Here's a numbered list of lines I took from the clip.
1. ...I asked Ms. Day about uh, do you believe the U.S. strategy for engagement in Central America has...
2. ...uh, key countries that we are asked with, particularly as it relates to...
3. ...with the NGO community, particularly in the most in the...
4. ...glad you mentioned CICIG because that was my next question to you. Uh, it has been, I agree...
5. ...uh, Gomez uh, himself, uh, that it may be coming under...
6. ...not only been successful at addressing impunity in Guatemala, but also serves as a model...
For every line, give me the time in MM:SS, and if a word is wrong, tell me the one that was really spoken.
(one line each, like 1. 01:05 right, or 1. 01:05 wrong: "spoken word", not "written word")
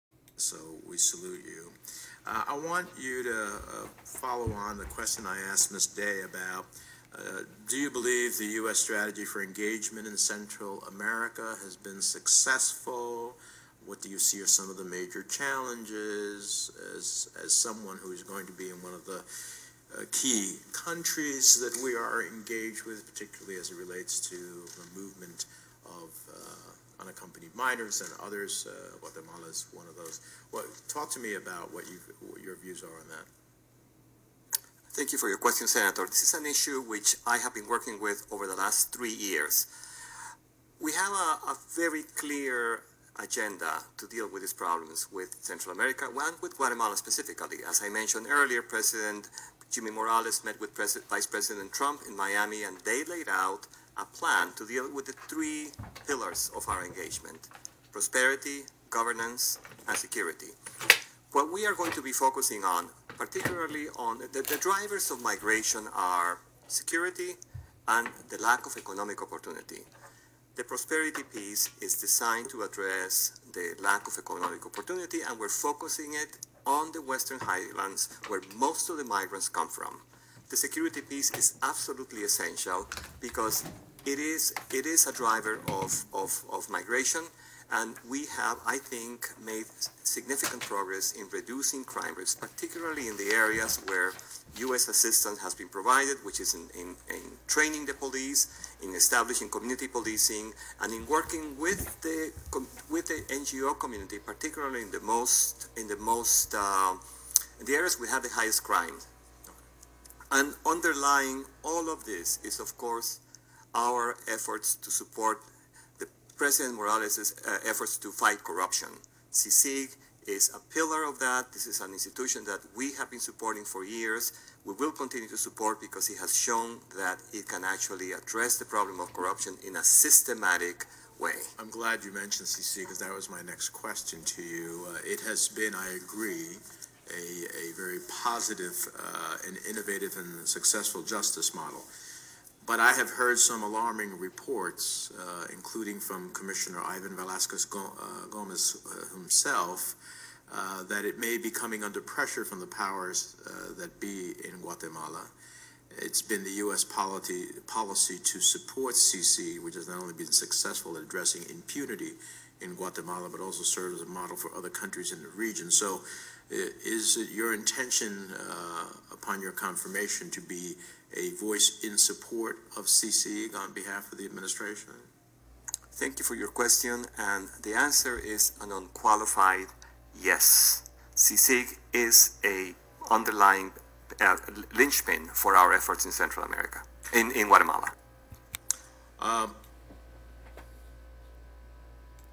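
1. 00:05 right
2. 00:19 wrong: "engaged", not "asked"
3. 01:42 right
4. 02:11 right
5. 02:27 right
6. 02:39 right.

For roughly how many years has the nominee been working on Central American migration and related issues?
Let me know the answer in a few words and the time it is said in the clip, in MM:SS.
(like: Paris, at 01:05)
3, at 00:38.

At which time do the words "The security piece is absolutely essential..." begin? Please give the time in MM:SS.
01:20.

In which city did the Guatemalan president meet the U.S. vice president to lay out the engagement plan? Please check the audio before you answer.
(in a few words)
Miami.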